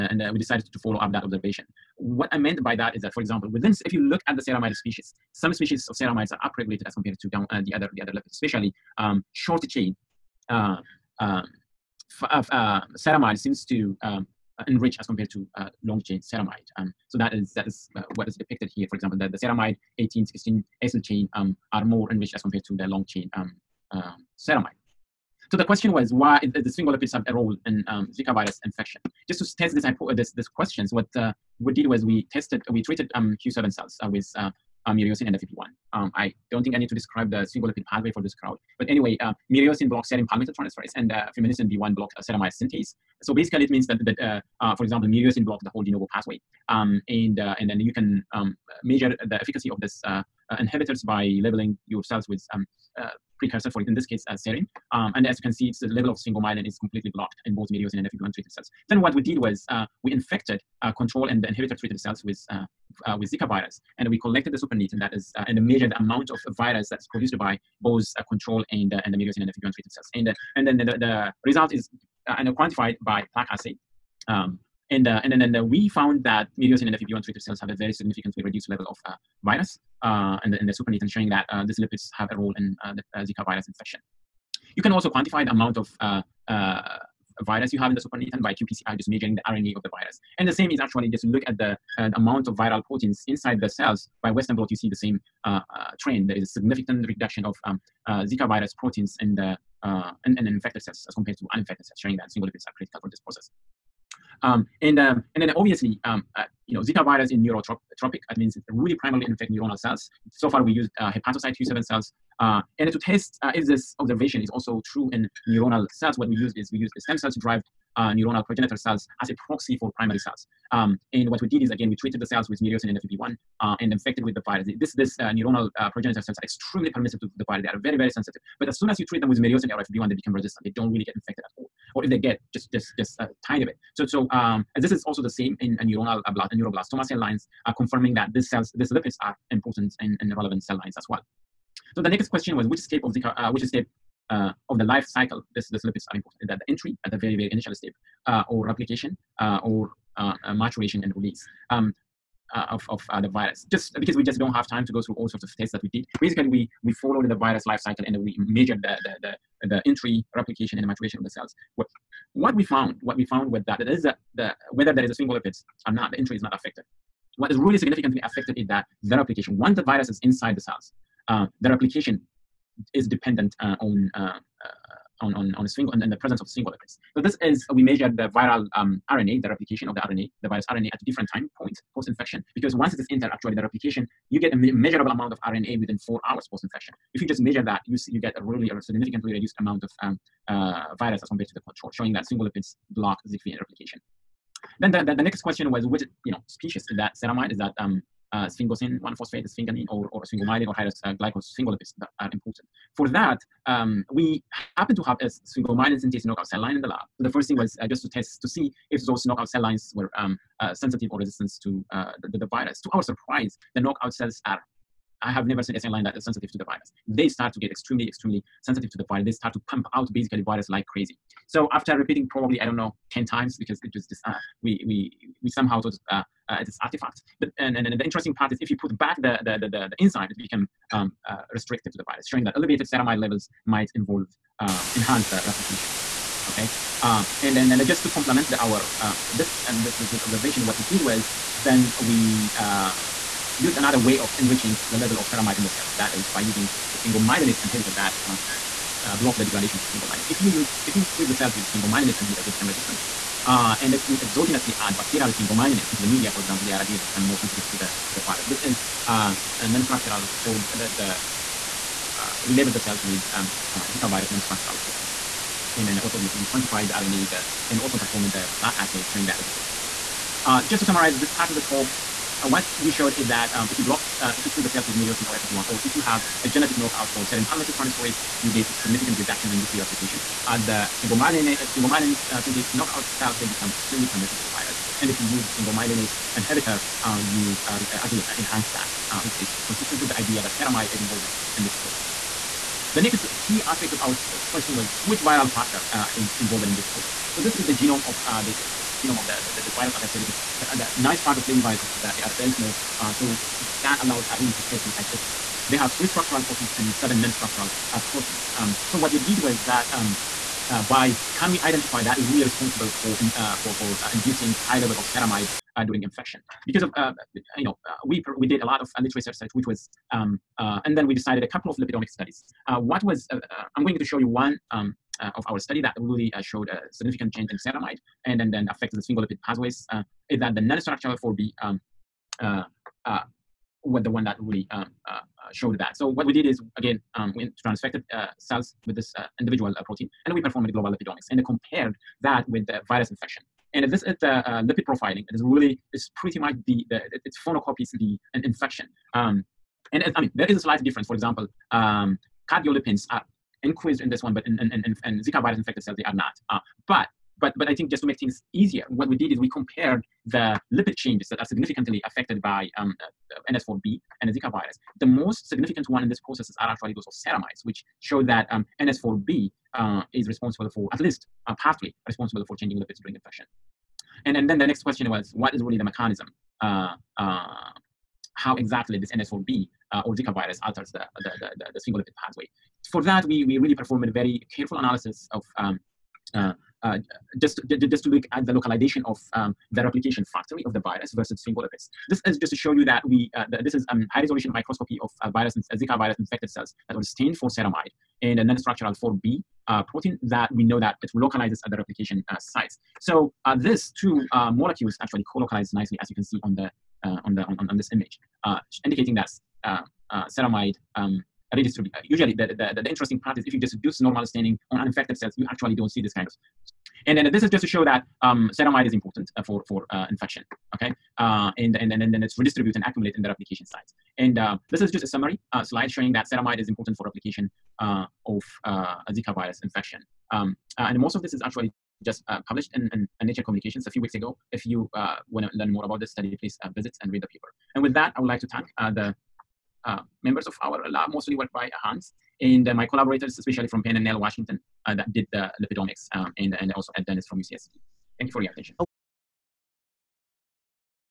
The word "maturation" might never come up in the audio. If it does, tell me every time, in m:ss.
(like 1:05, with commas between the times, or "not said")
2:30, 2:40.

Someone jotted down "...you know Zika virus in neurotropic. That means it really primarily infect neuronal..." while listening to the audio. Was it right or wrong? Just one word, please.
right.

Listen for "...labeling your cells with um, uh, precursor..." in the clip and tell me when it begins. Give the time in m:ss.
0:51.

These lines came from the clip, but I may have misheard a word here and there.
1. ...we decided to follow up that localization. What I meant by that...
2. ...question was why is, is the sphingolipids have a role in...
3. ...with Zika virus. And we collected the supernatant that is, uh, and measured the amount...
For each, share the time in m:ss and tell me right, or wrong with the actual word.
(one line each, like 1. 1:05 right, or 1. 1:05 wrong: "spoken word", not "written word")
1. 0:00 wrong: "observation", not "localization"
2. 0:25 right
3. 1:03 right.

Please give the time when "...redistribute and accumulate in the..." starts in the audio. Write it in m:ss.
7:02.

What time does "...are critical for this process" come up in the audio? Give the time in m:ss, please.
1:42.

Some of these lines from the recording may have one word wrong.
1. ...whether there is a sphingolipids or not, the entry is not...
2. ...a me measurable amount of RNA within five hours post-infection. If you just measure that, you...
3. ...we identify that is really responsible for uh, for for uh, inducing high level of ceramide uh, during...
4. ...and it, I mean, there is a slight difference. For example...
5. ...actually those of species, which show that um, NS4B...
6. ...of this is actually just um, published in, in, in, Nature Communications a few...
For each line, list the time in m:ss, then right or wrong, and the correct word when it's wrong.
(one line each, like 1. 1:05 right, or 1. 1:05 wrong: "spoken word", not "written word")
1. 2:44 right
2. 3:04 wrong: "four", not "five"
3. 5:11 right
4. 5:49 right
5. 6:06 wrong: "ceramides", not "species"
6. 7:11 right.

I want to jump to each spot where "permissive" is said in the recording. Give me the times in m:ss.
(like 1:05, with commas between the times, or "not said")
2:06, 4:44.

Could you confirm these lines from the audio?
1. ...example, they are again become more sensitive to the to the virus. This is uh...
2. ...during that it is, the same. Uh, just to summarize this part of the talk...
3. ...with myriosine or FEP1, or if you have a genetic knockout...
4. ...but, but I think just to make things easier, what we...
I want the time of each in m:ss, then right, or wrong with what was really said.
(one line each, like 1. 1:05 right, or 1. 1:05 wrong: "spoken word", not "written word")
1. 4:16 right
2. 4:29 wrong: "showing", not "during"
3. 4:34 right
4. 5:57 right.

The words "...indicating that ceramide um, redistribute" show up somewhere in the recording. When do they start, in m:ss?
6:48.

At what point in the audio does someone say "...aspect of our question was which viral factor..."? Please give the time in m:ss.
4:53.